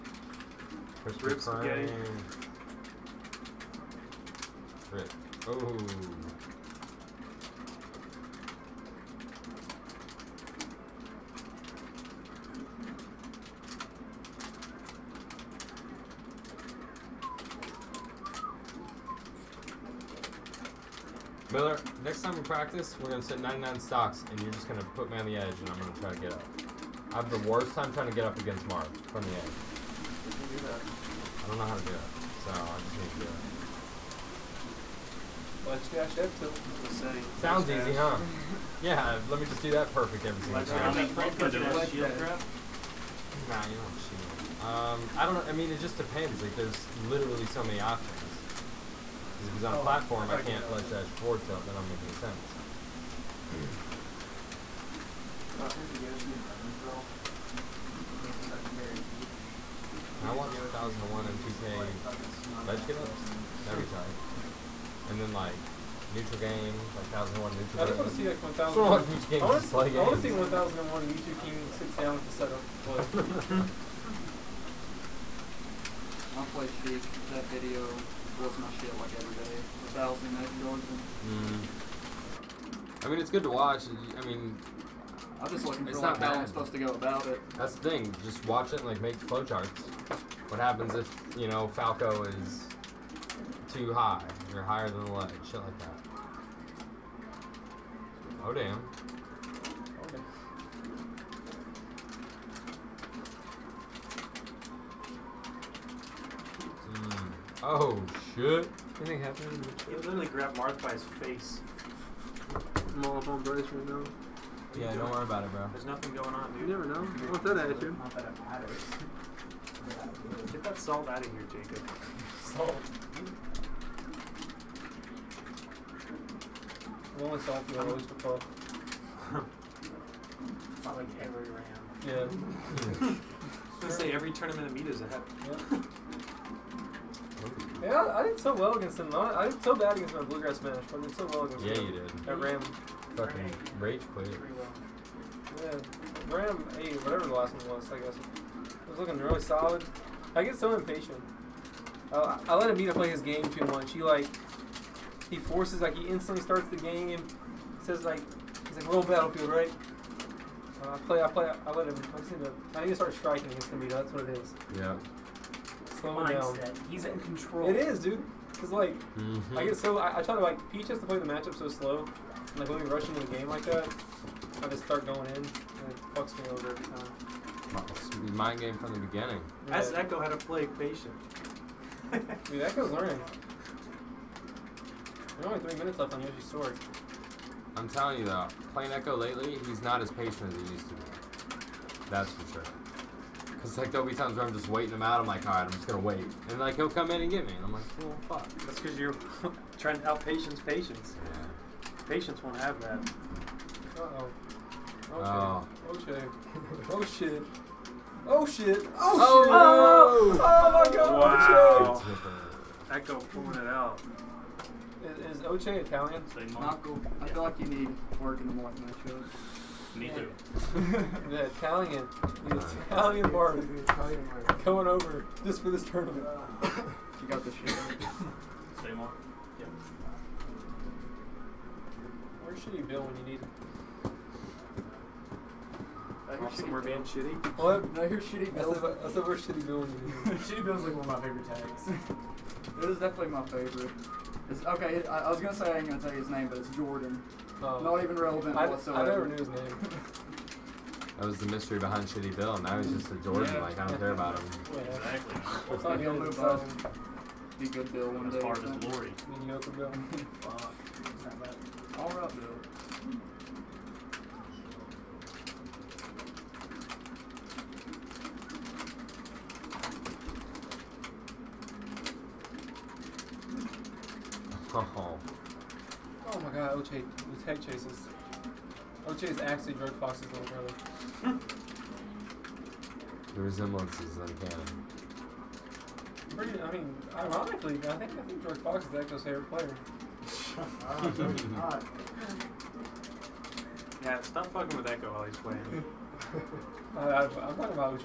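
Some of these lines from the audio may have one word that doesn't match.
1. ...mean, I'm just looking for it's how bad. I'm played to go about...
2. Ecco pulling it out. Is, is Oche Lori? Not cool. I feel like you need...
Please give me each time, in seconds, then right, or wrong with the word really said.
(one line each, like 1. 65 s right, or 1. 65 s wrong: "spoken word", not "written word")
1. 84 s wrong: "supposed", not "played"
2. 212 s wrong: "Italian", not "Lori".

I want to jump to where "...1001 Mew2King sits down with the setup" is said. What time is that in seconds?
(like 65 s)
70 s.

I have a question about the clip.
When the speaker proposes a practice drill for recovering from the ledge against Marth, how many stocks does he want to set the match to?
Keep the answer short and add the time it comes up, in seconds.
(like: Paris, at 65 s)
99, at 23 s.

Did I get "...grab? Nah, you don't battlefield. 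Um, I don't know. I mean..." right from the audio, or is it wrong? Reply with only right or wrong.
wrong.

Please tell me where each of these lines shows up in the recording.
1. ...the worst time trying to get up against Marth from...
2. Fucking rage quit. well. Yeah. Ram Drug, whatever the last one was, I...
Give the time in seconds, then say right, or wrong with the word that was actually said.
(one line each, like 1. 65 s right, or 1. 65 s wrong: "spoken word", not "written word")
1. 27 s right
2. 143 s wrong: "Hey", not "Drug".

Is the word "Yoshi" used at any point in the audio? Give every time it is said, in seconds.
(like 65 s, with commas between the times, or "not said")
55 s, 186 s.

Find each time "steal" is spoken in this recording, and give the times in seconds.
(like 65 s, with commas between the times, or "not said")
not said.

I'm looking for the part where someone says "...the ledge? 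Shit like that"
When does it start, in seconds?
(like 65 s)
95 s.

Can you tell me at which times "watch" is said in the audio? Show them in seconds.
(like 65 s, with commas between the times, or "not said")
60 s, 83 s, 88 s.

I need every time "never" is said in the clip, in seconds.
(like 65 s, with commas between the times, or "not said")
116 s, 249 s.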